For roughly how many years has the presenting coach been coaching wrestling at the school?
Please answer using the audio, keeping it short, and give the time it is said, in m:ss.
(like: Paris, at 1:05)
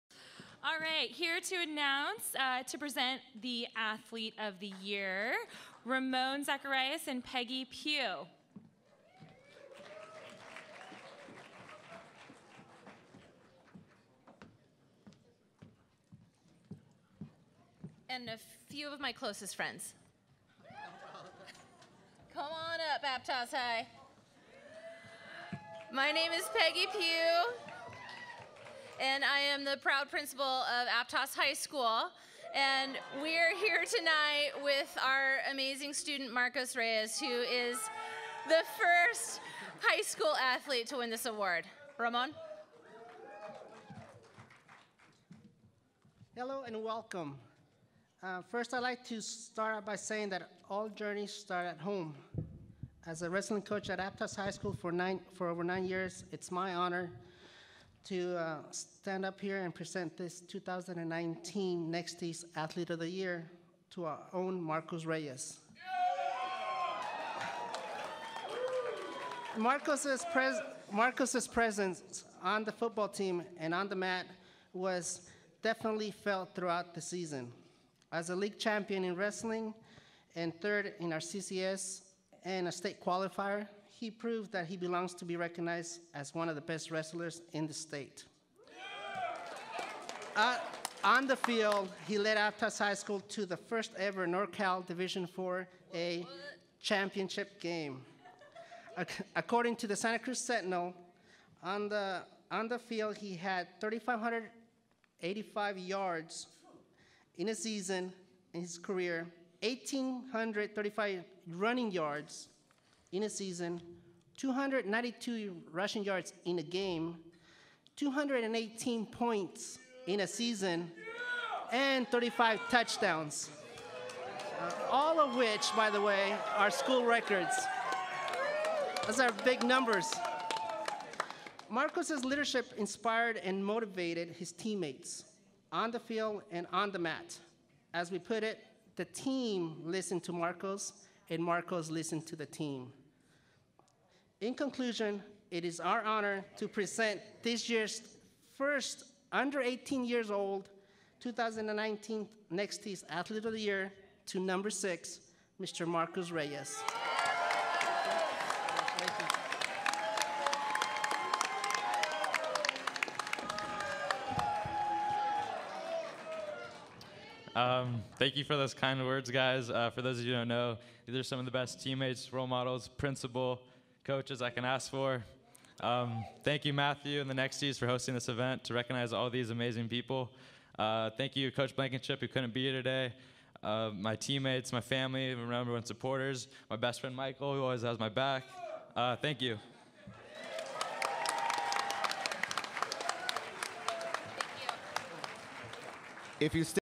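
over 9 years, at 0:55.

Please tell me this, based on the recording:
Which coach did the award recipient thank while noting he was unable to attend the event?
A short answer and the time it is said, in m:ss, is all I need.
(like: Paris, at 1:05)
Coach Blankenship, at 3:01.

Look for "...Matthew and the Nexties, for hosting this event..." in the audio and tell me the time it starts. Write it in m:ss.
2:56.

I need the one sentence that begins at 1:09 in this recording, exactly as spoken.
Marcos's, pres Marcos's presence on the football team and on the mat was definitely felt throughout the season.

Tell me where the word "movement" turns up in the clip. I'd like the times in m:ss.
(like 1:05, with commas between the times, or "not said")
not said.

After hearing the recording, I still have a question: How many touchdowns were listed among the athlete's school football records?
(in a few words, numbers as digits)
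35.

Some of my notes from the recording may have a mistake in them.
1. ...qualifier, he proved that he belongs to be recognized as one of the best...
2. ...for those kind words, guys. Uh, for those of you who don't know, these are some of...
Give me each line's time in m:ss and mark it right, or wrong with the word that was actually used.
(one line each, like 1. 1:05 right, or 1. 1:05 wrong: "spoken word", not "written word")
1. 1:23 right
2. 2:48 right.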